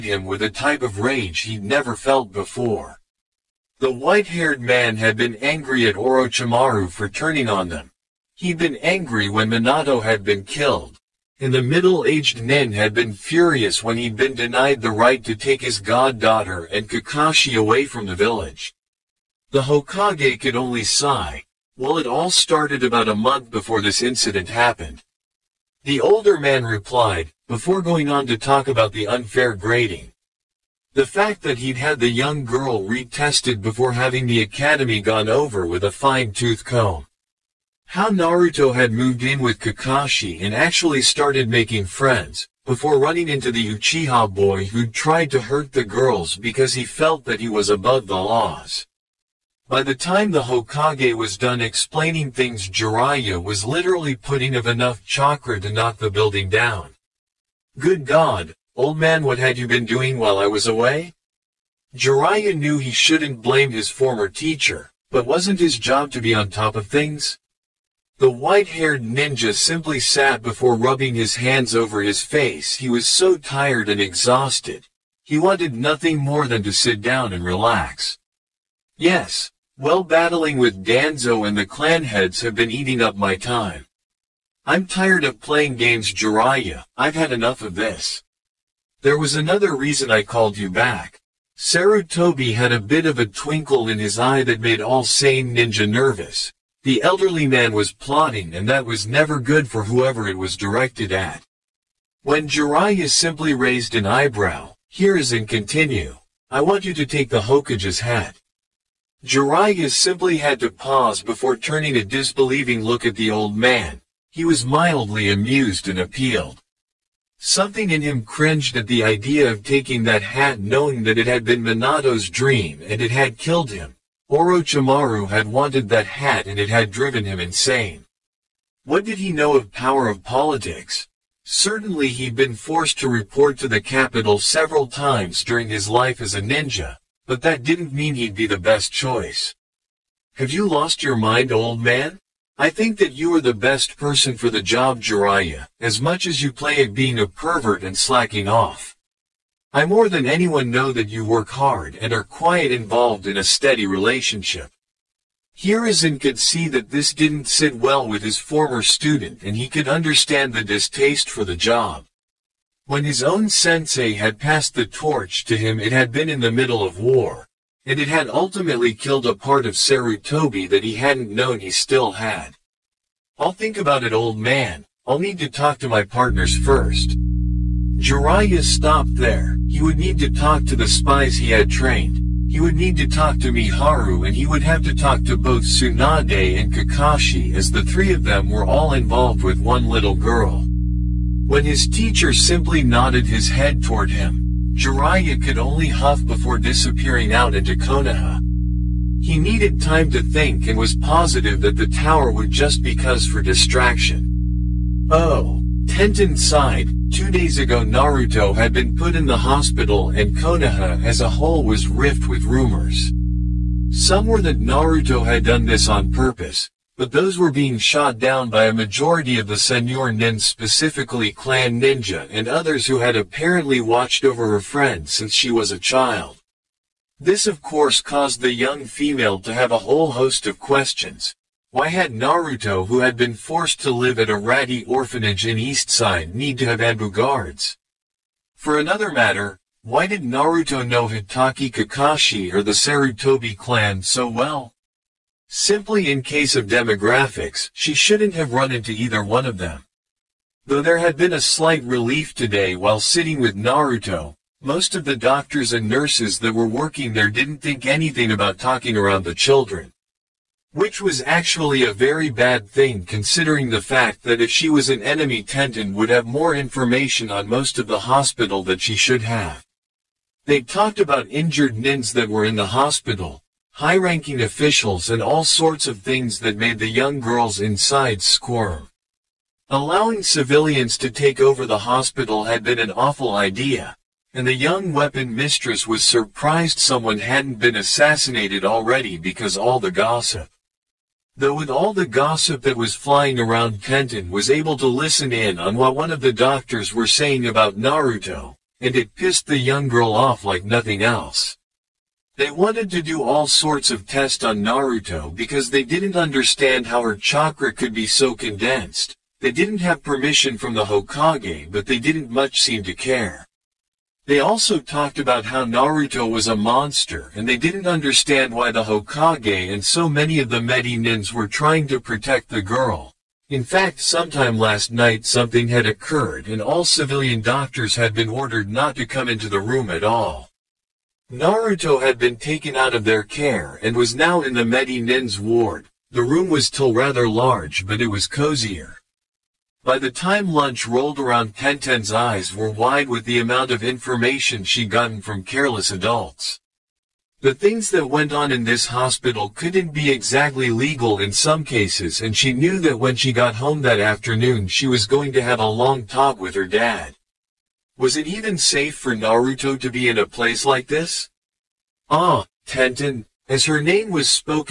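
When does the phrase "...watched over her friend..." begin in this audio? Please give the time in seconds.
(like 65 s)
223 s.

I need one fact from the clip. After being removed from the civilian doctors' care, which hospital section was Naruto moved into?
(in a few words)
Medi Nin's ward.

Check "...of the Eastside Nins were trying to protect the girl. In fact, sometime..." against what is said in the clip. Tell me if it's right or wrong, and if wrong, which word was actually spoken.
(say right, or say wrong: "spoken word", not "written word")
wrong: "Medi", not "Eastside".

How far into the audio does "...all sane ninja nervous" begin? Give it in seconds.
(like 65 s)
94 s.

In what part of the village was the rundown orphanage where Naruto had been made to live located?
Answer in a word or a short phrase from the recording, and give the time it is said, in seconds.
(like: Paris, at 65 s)
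Eastside, at 235 s.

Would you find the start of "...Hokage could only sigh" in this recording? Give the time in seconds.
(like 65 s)
19 s.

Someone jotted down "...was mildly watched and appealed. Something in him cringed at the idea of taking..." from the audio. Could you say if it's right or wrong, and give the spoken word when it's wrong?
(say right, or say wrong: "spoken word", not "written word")
wrong: "amused", not "watched".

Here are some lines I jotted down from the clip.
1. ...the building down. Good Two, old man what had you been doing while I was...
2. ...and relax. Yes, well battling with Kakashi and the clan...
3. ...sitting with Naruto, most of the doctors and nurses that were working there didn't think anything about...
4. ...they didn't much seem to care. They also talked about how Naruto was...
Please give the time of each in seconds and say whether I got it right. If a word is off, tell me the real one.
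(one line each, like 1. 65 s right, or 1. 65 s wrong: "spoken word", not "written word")
1. 55 s wrong: "God", not "Two"
2. 77 s wrong: "Danzo", not "Kakashi"
3. 252 s right
4. 311 s right.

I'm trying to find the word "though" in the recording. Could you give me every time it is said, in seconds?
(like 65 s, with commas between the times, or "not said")
250 s, 291 s.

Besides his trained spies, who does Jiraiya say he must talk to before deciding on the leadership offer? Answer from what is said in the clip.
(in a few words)
Miharu.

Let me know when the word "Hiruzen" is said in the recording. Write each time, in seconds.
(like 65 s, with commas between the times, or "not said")
104 s, 155 s.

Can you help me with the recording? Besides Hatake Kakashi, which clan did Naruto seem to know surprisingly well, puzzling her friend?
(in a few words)
Sarutobi clan.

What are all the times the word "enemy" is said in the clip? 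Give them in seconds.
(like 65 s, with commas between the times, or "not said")
265 s.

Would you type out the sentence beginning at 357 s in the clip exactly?
Was it even safe for Naruto to be in a place like this?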